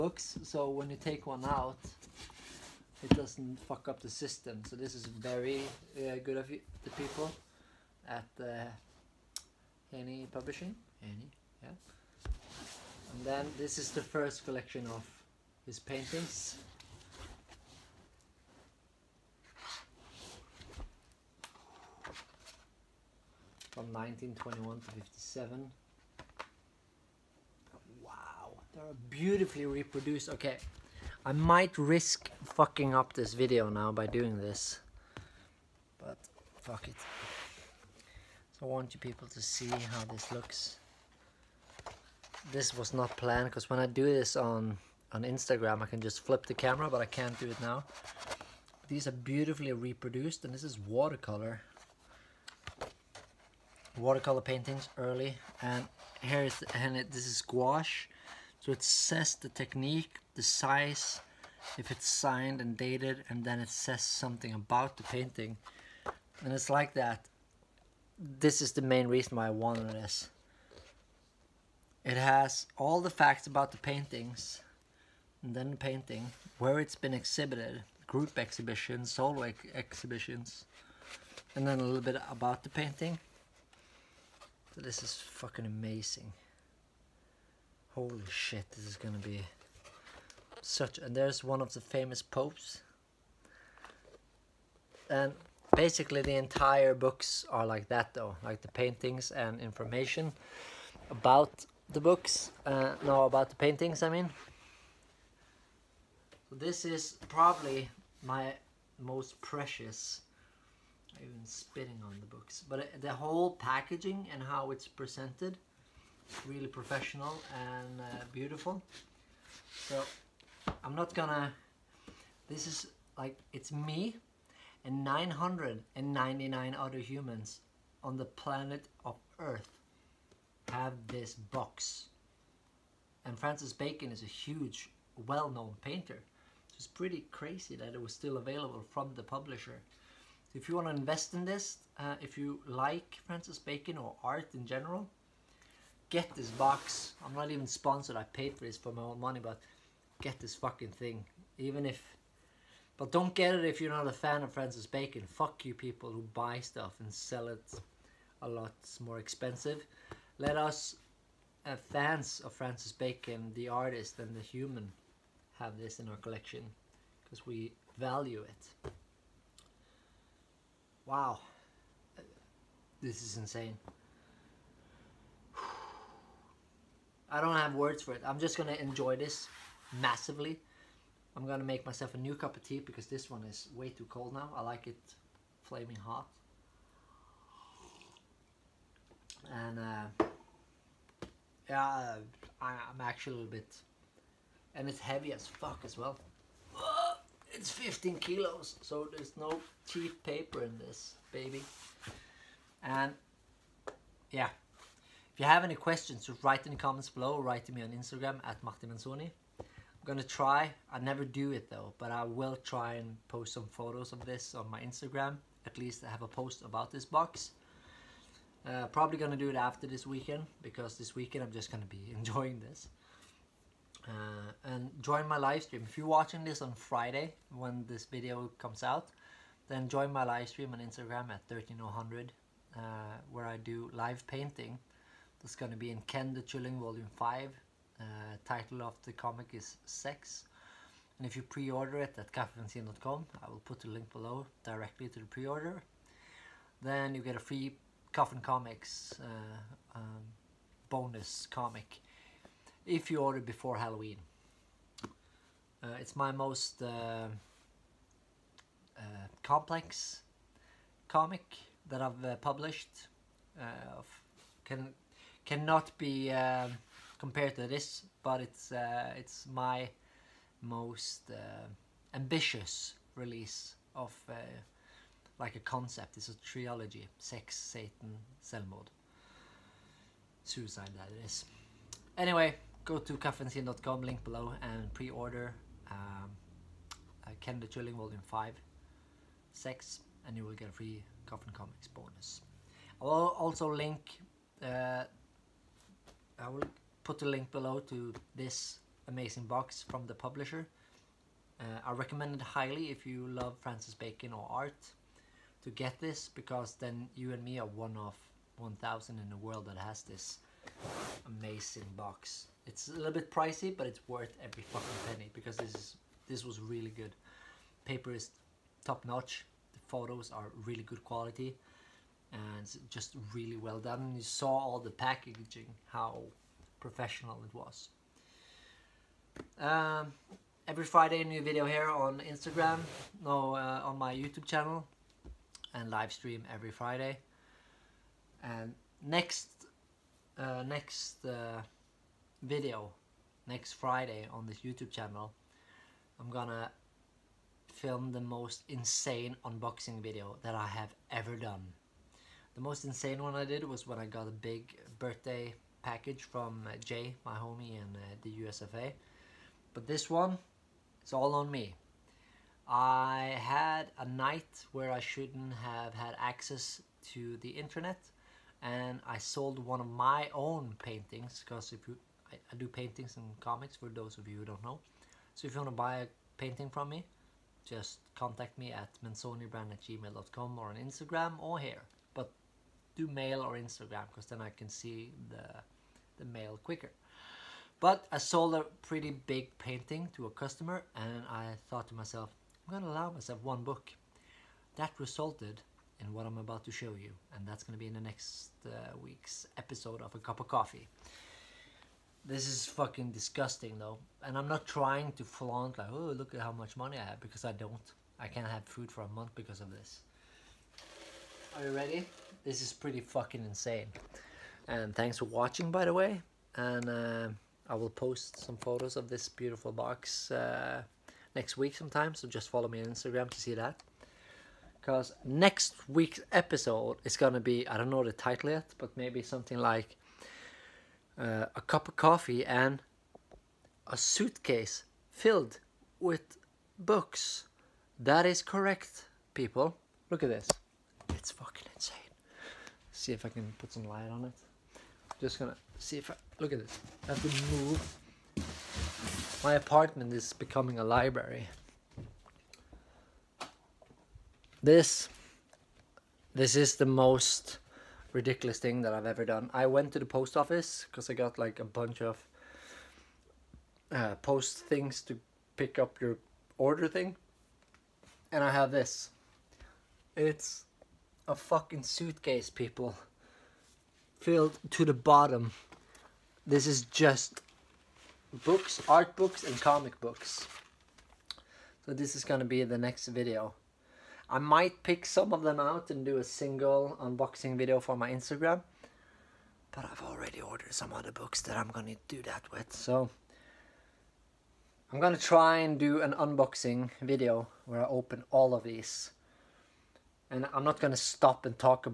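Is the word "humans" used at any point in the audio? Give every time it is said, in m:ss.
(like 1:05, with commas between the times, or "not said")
2:06, 2:44.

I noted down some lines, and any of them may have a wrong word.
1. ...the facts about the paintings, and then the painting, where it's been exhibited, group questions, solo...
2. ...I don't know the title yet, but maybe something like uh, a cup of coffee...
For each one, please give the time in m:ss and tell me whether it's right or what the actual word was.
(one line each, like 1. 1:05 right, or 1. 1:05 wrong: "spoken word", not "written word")
1. 1:13 wrong: "exhibitions", not "questions"
2. 7:07 right.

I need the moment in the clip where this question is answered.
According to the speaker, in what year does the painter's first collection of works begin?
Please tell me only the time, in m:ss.
0:23.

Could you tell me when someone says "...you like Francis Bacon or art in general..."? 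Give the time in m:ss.
2:22.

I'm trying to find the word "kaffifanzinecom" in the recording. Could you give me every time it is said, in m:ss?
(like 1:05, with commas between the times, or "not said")
4:02, 4:43.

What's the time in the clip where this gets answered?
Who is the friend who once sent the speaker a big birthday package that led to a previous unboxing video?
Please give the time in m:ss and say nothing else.
5:56.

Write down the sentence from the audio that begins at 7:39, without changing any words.
I went to the post office because I got like a bunch of uh, post things to pick up your order thing.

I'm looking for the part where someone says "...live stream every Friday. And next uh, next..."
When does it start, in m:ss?
5:35.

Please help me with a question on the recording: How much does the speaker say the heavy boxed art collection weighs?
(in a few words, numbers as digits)
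15 kilos.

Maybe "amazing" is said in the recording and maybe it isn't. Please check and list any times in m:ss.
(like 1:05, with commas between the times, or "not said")
1:25, 4:59, 5:11.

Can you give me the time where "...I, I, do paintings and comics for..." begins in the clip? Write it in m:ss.
6:12.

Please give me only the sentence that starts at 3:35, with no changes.
At least I have a post about this box.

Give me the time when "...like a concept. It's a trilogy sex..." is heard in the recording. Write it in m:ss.
4:35.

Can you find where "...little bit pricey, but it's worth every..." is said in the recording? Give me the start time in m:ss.
5:12.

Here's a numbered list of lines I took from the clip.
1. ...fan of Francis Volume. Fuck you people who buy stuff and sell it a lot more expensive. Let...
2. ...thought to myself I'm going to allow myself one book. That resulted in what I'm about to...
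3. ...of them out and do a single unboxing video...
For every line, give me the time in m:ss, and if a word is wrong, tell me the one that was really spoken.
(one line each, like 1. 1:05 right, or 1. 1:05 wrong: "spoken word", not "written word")
1. 2:34 wrong: "Bacon", not "Volume"
2. 6:31 right
3. 8:05 right.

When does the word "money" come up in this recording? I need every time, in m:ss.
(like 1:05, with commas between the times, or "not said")
2:29, 6:46.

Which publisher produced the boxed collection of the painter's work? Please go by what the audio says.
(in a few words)
Haney Publishing.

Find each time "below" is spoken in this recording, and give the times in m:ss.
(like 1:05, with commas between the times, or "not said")
3:27, 4:04, 4:44, 4:57.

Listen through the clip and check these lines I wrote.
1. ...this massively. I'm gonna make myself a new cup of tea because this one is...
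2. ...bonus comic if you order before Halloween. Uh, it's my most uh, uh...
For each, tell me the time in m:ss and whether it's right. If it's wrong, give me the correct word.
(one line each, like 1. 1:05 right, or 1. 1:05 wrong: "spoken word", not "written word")
1. 2:59 right
2. 4:10 right.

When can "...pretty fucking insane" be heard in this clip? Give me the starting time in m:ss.
6:52.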